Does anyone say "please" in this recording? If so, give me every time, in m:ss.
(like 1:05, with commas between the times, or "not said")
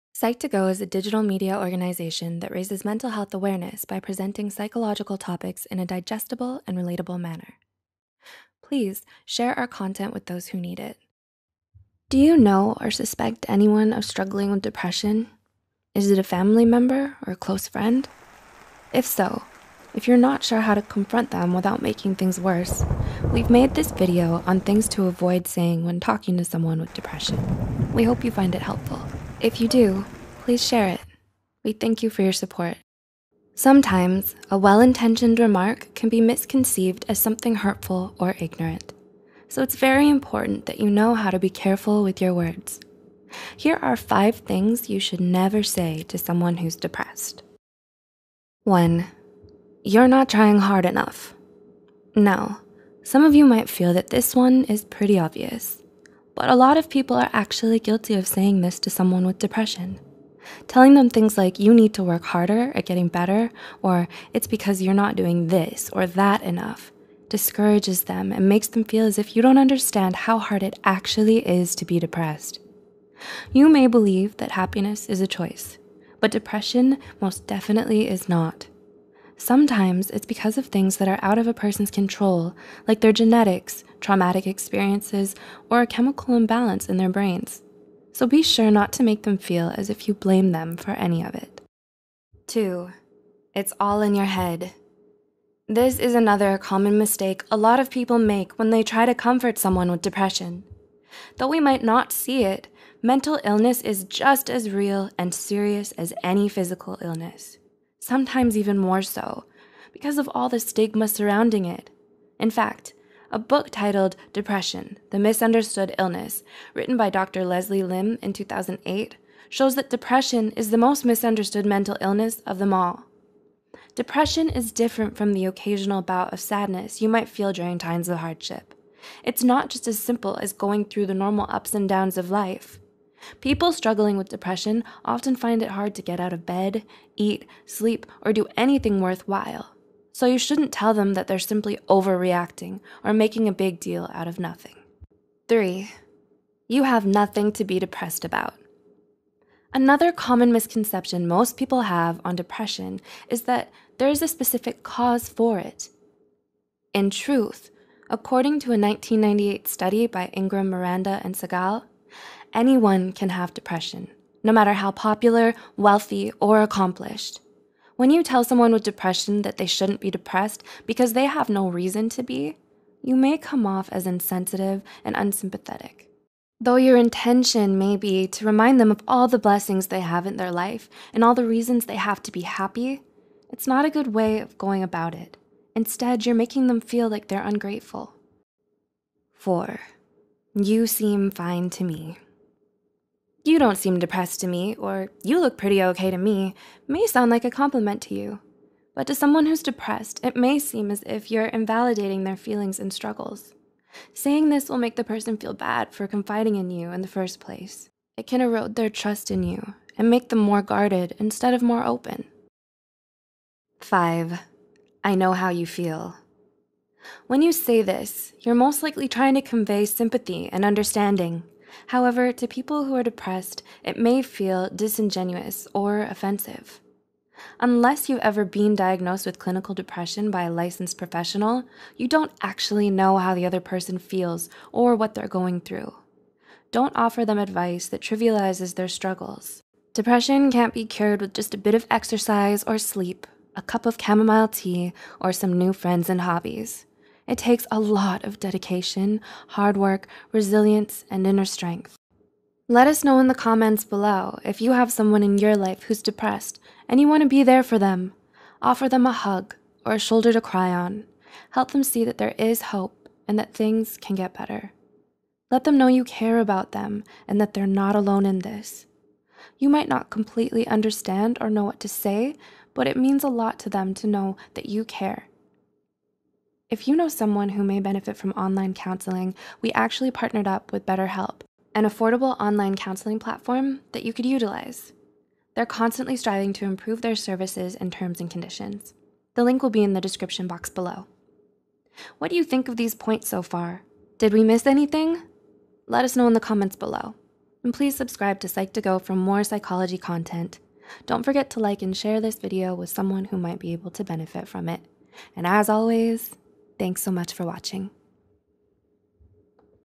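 0:08, 0:30, 4:57.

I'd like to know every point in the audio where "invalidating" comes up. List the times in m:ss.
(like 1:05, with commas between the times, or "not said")
3:21.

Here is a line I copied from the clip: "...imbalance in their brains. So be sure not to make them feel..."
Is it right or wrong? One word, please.
right.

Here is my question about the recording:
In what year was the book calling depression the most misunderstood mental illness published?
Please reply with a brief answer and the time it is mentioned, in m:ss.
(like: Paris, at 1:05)
2008, at 1:58.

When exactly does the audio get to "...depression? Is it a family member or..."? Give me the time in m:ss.
0:14.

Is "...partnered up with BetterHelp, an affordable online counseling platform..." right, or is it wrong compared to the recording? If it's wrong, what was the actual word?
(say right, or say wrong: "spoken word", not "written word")
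right.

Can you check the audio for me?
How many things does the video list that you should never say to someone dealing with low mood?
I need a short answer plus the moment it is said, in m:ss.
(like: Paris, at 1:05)
5, at 0:43.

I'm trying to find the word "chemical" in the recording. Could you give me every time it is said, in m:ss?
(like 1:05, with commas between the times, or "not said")
1:25.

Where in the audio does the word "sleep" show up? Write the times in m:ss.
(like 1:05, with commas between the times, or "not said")
2:17, 4:02.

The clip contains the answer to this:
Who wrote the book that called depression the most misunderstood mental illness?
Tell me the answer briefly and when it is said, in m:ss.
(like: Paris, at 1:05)
Dr. Leslie Lim, at 1:57.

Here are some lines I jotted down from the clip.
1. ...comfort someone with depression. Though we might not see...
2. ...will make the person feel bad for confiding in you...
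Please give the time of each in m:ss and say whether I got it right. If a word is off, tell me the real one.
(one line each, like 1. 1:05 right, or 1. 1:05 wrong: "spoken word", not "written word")
1. 1:39 right
2. 3:24 right.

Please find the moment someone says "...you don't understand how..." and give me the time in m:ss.
1:09.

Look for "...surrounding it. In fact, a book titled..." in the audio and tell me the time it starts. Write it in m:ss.
1:51.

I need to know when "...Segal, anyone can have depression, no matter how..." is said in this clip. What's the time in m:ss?
2:41.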